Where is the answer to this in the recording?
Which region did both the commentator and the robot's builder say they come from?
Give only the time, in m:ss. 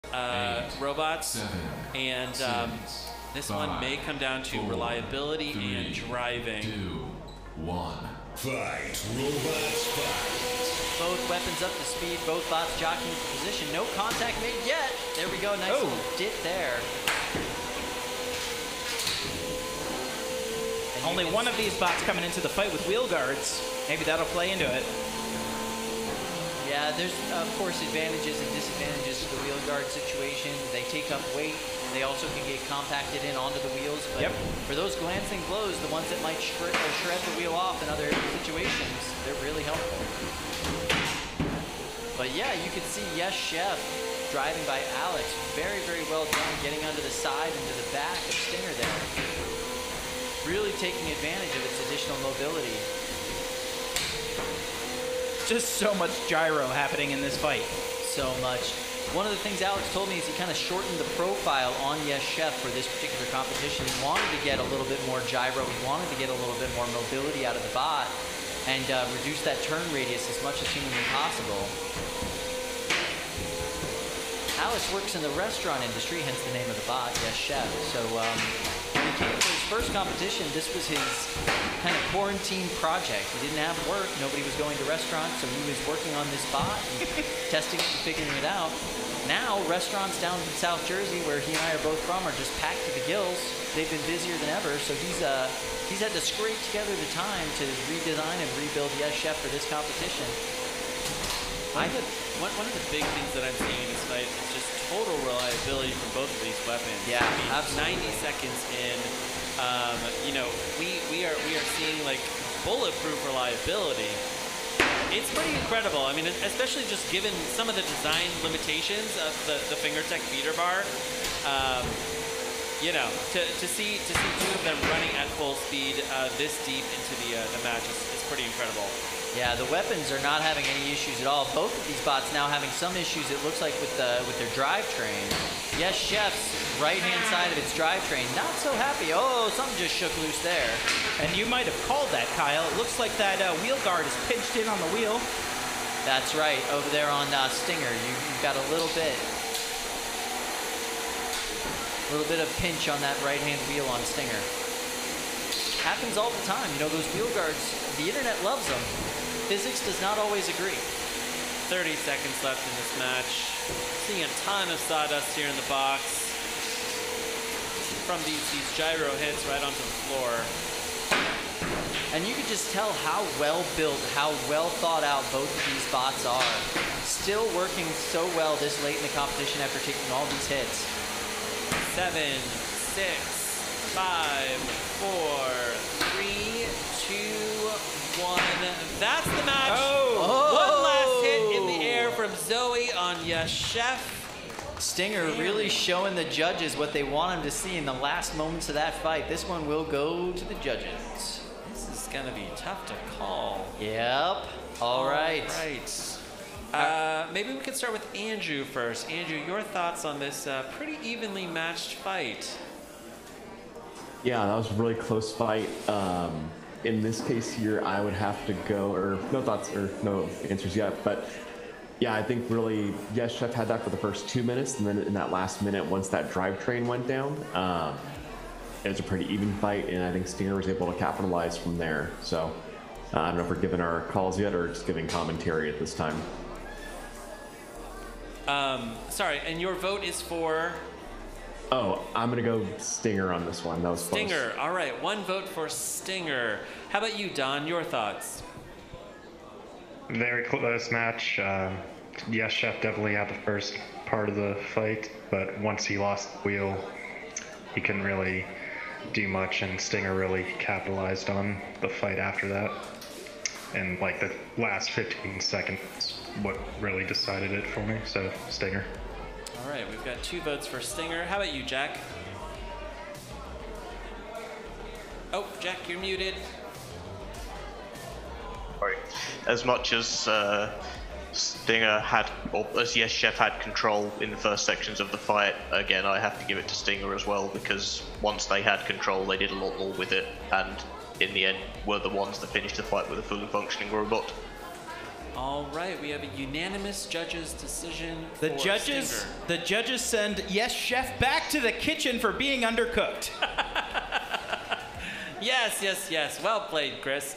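1:30.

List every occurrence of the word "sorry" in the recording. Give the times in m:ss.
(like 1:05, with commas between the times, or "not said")
3:59, 4:38.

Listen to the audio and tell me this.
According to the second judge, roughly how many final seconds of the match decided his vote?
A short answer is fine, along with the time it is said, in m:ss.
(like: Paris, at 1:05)
15, at 4:24.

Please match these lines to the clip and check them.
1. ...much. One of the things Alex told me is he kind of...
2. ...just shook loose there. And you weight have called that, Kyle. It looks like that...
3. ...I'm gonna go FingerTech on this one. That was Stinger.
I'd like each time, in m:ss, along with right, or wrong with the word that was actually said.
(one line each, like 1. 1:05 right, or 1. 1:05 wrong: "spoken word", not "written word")
1. 0:58 right
2. 2:19 wrong: "might", not "weight"
3. 4:02 wrong: "Stinger", not "FingerTech".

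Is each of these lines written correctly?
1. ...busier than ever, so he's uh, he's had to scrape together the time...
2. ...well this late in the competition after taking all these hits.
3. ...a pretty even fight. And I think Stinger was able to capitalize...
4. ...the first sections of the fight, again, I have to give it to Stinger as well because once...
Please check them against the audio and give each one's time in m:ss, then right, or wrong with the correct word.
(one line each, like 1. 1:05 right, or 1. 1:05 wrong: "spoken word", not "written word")
1. 1:34 right
2. 2:58 right
3. 3:48 right
4. 4:44 right.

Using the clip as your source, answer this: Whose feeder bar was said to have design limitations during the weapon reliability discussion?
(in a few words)
FingerTech.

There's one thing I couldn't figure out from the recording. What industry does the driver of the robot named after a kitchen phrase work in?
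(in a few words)
Restaurant industry.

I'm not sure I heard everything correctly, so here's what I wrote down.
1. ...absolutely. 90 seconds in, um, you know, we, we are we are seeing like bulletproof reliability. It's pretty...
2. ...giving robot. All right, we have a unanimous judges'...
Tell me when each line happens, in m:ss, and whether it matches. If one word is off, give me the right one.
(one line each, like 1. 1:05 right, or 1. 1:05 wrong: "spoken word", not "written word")
1. 1:48 right
2. 4:53 wrong: "functioning", not "giving".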